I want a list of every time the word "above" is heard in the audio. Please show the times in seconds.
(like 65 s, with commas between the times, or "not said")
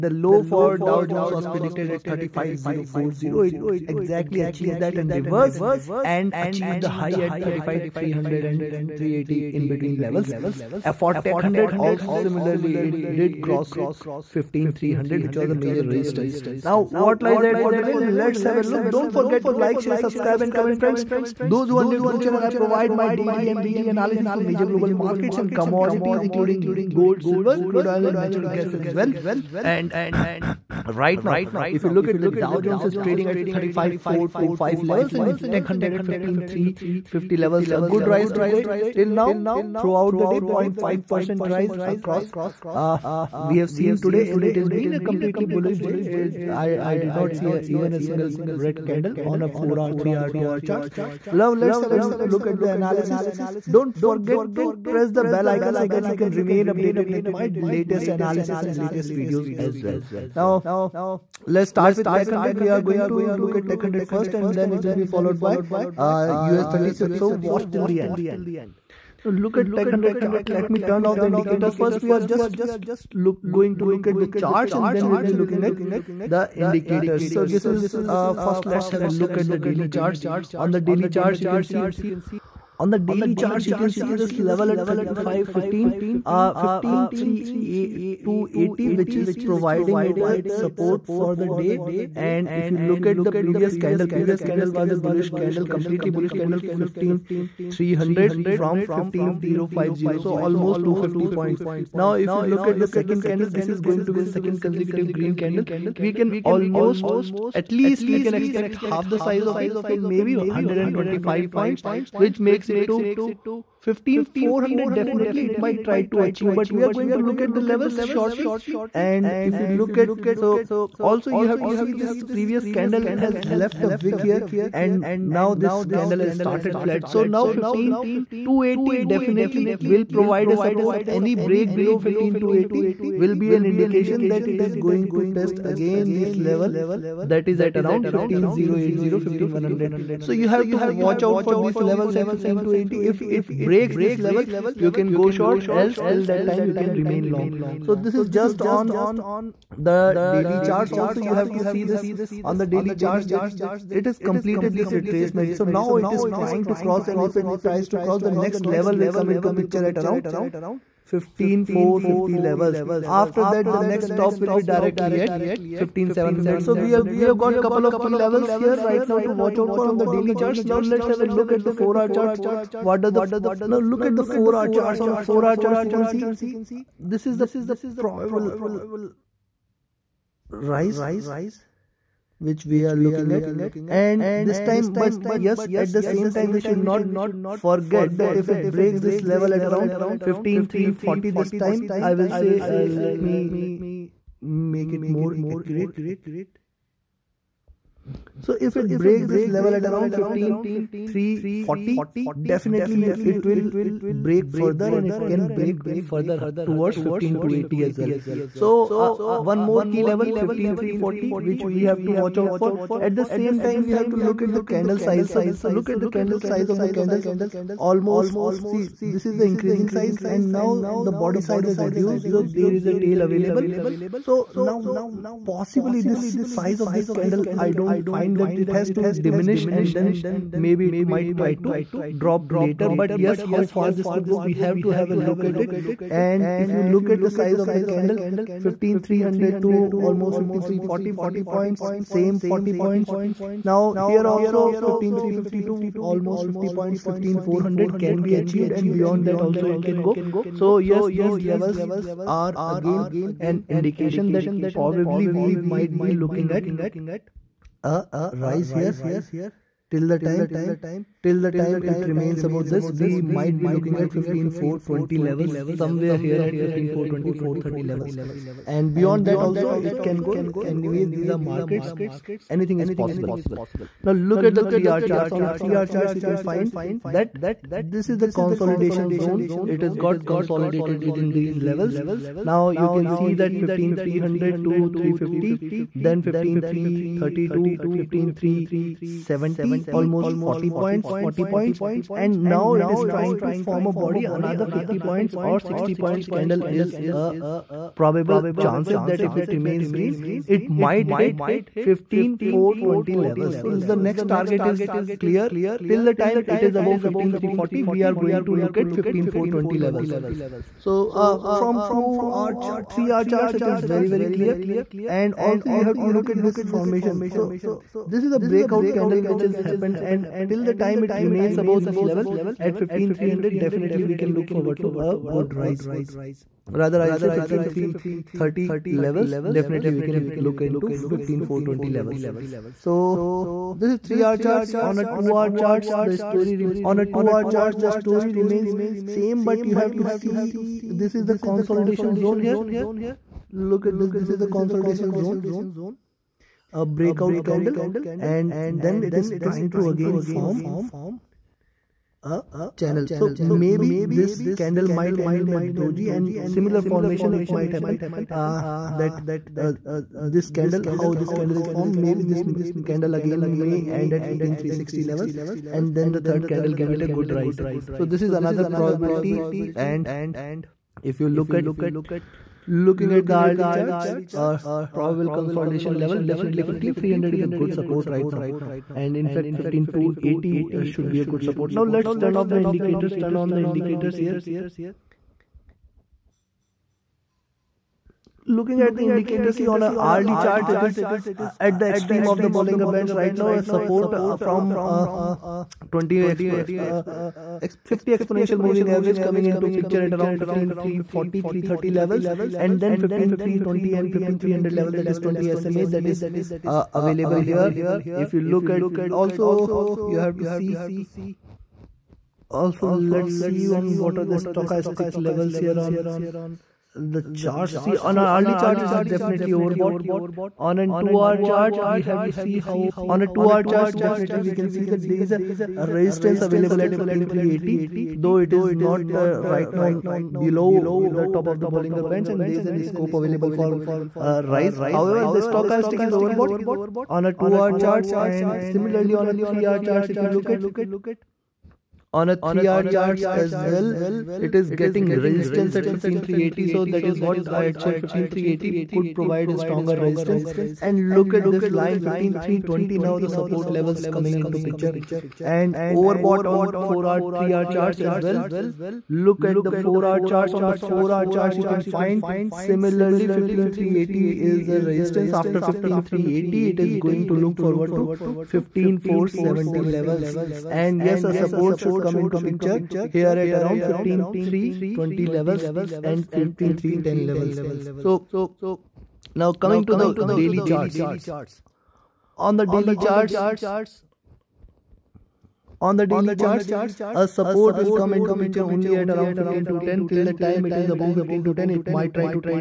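306 s, 321 s, 490 s.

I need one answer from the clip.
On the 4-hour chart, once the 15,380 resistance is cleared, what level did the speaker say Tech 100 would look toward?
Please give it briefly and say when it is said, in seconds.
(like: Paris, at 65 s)
15470, at 468 s.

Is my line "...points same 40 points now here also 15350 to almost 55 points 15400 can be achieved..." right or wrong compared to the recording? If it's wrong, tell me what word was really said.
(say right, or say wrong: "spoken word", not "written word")
wrong: "50", not "55".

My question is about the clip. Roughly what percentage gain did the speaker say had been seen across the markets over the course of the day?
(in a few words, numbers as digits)
0.5%.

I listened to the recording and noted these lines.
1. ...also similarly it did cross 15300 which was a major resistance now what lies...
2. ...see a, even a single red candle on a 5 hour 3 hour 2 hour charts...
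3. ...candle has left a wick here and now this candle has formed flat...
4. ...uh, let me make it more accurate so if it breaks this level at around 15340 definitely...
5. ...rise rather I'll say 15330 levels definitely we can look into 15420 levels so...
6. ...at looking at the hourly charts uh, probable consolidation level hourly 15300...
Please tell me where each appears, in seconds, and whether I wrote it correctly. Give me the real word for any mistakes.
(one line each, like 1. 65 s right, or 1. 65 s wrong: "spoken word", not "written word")
1. 11 s right
2. 47 s wrong: "4", not "5"
3. 122 s wrong: "started", not "formed"
4. 192 s right
5. 325 s right
6. 371 s wrong: "definitely", not "hourly".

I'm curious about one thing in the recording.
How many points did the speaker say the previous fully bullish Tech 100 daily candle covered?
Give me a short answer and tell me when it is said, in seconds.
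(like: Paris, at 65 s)
250, at 100 s.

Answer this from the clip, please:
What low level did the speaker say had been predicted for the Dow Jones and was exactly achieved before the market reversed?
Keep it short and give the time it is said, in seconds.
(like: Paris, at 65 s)
35040, at 2 s.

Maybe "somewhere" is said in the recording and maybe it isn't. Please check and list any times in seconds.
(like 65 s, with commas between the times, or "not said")
265 s.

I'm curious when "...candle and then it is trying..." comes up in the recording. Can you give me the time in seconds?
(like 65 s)
347 s.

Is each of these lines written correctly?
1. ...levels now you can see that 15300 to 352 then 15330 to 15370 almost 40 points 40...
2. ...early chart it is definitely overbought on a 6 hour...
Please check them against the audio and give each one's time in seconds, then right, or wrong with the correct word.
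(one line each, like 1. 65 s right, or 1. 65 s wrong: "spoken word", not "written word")
1. 281 s wrong: "350", not "352"
2. 418 s wrong: "2", not "6".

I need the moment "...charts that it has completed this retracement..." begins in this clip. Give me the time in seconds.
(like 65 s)
153 s.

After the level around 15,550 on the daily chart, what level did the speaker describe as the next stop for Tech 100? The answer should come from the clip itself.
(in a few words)
15700.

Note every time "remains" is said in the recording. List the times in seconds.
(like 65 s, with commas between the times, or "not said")
56 s, 147 s, 262 s, 299 s, 321 s, 338 s.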